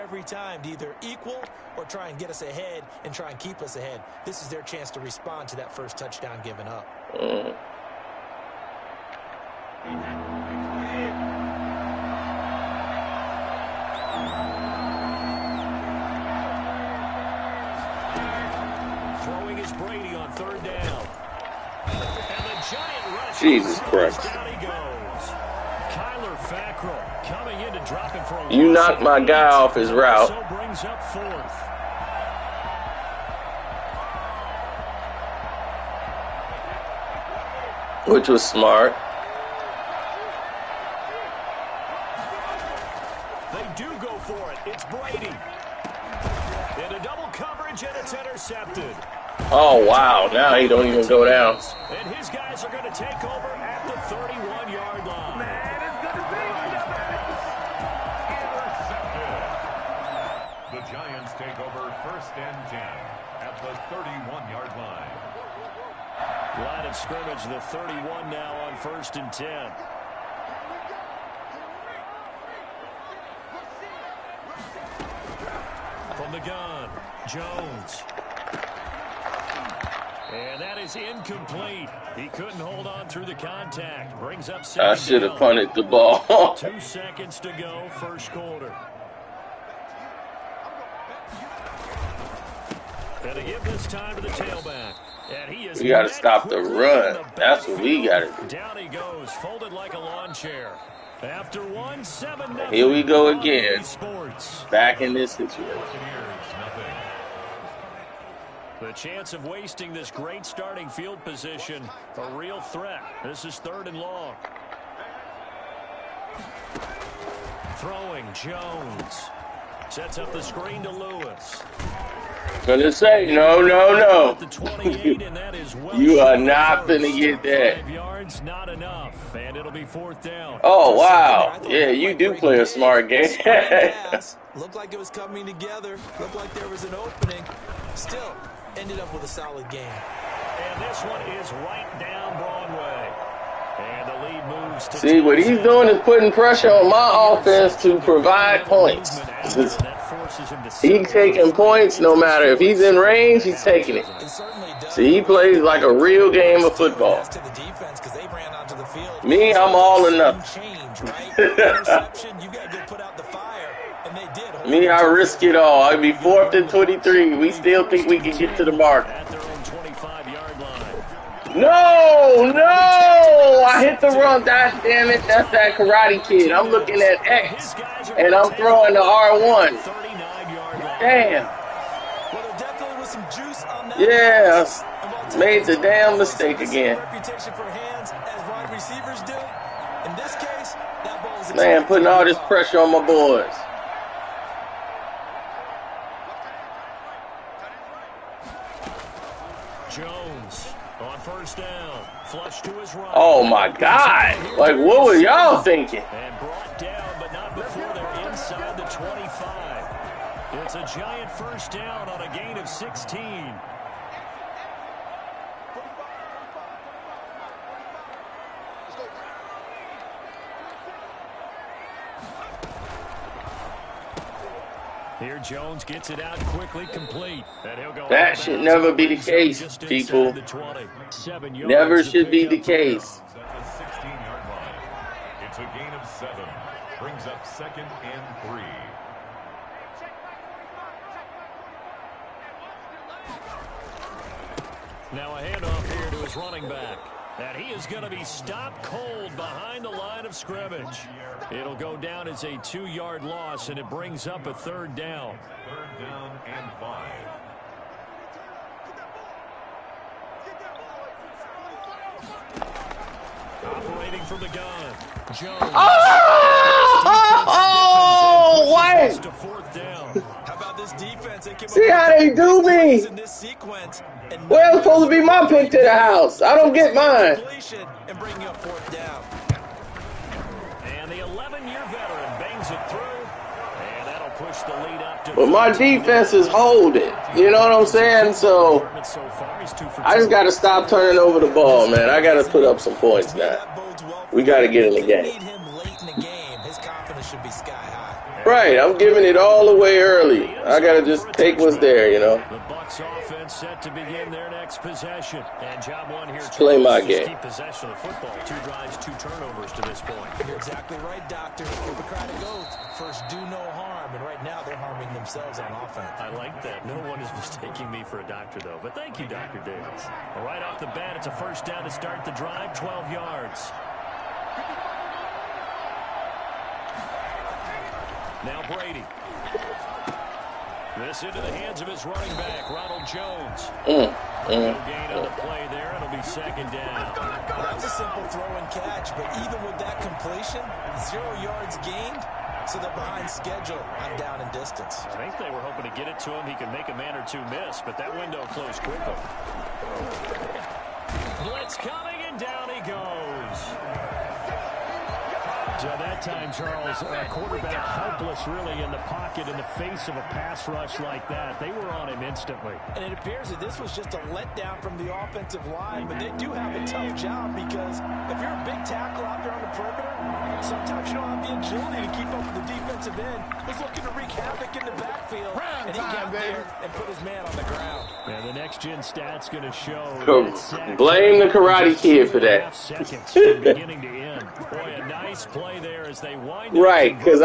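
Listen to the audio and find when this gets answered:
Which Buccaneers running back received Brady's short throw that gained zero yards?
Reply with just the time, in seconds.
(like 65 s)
332 s.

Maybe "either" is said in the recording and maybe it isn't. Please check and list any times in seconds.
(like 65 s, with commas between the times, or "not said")
0 s.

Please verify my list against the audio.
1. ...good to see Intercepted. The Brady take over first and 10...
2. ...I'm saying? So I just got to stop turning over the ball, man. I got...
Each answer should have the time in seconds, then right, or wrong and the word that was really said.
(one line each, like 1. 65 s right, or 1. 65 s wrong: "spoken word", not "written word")
1. 56 s wrong: "Giants", not "Brady"
2. 287 s right.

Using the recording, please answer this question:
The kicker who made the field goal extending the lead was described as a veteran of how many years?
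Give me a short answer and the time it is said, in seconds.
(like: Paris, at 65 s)
11, at 281 s.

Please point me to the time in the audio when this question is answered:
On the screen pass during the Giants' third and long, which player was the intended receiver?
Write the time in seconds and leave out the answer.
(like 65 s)
120 s.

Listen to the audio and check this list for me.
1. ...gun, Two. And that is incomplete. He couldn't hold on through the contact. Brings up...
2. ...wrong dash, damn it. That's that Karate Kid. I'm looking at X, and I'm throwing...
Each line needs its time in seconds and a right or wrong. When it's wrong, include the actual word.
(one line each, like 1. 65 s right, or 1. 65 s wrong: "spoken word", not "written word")
1. 76 s wrong: "Jones", not "Two"
2. 174 s right.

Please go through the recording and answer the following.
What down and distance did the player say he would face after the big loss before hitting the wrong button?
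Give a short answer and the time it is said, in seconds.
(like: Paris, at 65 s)
Fourth and 23, at 166 s.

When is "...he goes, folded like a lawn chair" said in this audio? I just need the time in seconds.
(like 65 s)
98 s.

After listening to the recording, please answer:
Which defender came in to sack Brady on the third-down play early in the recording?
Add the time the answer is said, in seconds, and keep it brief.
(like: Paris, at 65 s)
Kyler Fackrell, at 25 s.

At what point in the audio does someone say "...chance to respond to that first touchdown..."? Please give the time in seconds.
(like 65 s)
4 s.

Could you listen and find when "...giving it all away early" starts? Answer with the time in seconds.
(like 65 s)
298 s.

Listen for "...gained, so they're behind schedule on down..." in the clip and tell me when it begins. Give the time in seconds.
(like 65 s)
341 s.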